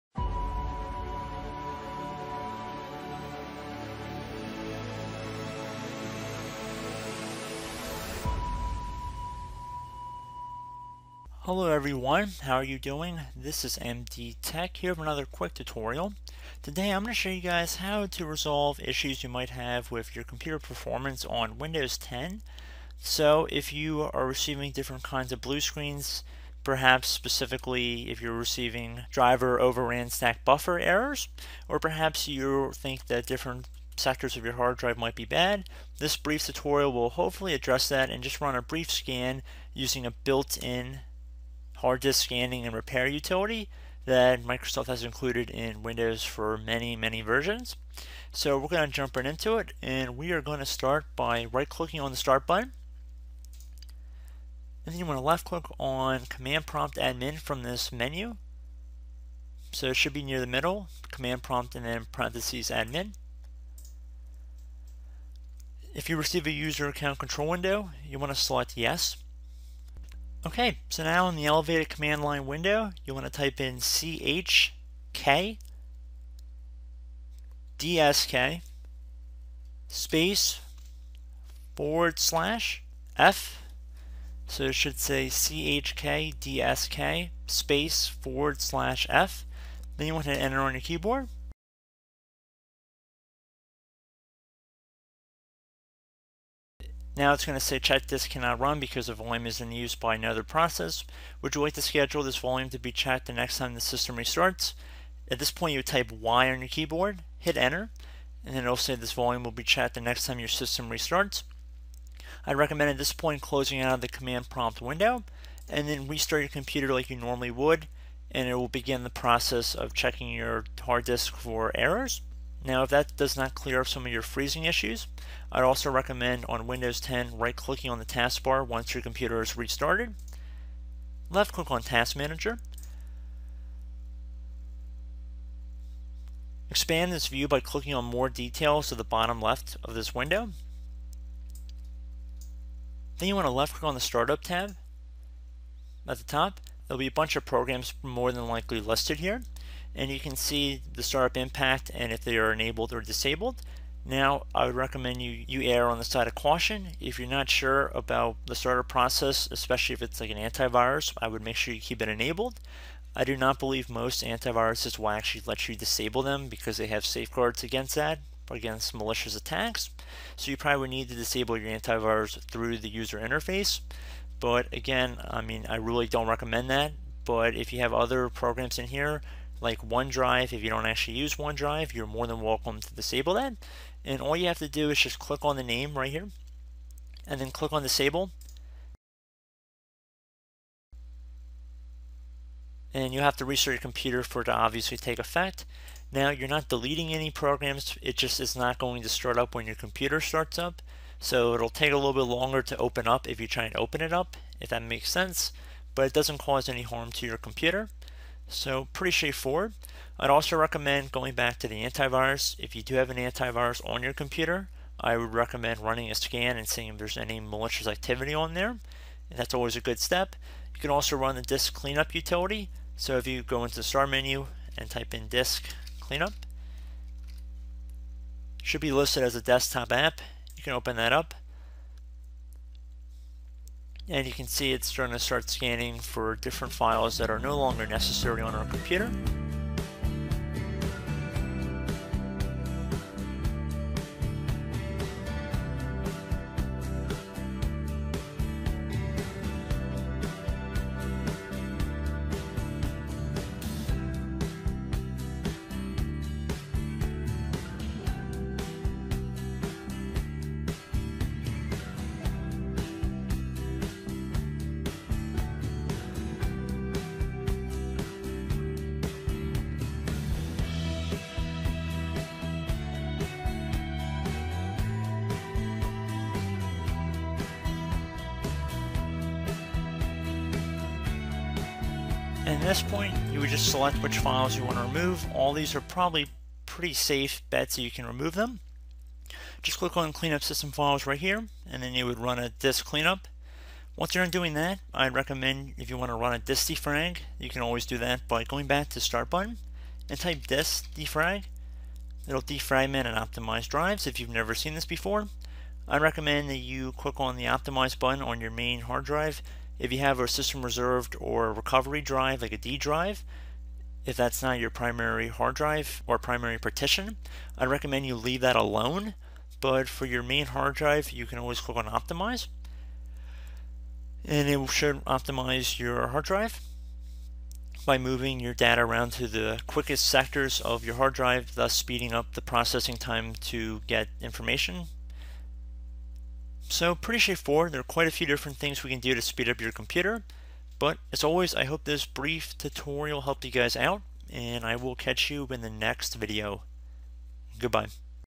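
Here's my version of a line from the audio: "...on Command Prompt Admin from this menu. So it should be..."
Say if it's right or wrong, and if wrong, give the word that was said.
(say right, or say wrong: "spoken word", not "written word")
right.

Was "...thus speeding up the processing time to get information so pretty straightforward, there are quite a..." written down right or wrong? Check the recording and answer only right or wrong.
right.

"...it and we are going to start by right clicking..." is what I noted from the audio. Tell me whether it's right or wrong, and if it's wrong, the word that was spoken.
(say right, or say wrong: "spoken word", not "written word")
right.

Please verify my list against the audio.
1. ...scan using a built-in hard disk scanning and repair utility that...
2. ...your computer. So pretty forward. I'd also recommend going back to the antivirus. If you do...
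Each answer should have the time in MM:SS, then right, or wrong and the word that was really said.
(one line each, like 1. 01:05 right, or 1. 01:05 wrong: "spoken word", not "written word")
1. 00:38 right
2. 03:27 wrong: "straightforward", not "forward".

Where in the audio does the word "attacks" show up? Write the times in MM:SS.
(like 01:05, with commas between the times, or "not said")
02:49.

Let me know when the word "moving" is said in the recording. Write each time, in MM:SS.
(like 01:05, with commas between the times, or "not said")
05:27.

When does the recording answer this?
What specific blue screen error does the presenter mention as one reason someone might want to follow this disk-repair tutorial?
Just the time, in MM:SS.
00:29.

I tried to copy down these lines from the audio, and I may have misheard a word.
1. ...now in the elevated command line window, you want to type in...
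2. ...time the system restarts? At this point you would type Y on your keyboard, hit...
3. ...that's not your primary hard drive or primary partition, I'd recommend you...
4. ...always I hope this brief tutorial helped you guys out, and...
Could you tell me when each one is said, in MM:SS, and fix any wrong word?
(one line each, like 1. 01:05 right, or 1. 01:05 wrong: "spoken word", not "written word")
1. 01:11 right
2. 01:43 right
3. 05:14 right
4. 05:41 right.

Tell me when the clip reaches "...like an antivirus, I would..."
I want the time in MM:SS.
02:40.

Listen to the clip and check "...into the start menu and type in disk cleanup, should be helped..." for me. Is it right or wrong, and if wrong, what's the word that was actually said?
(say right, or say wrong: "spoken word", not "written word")
wrong: "listed", not "helped".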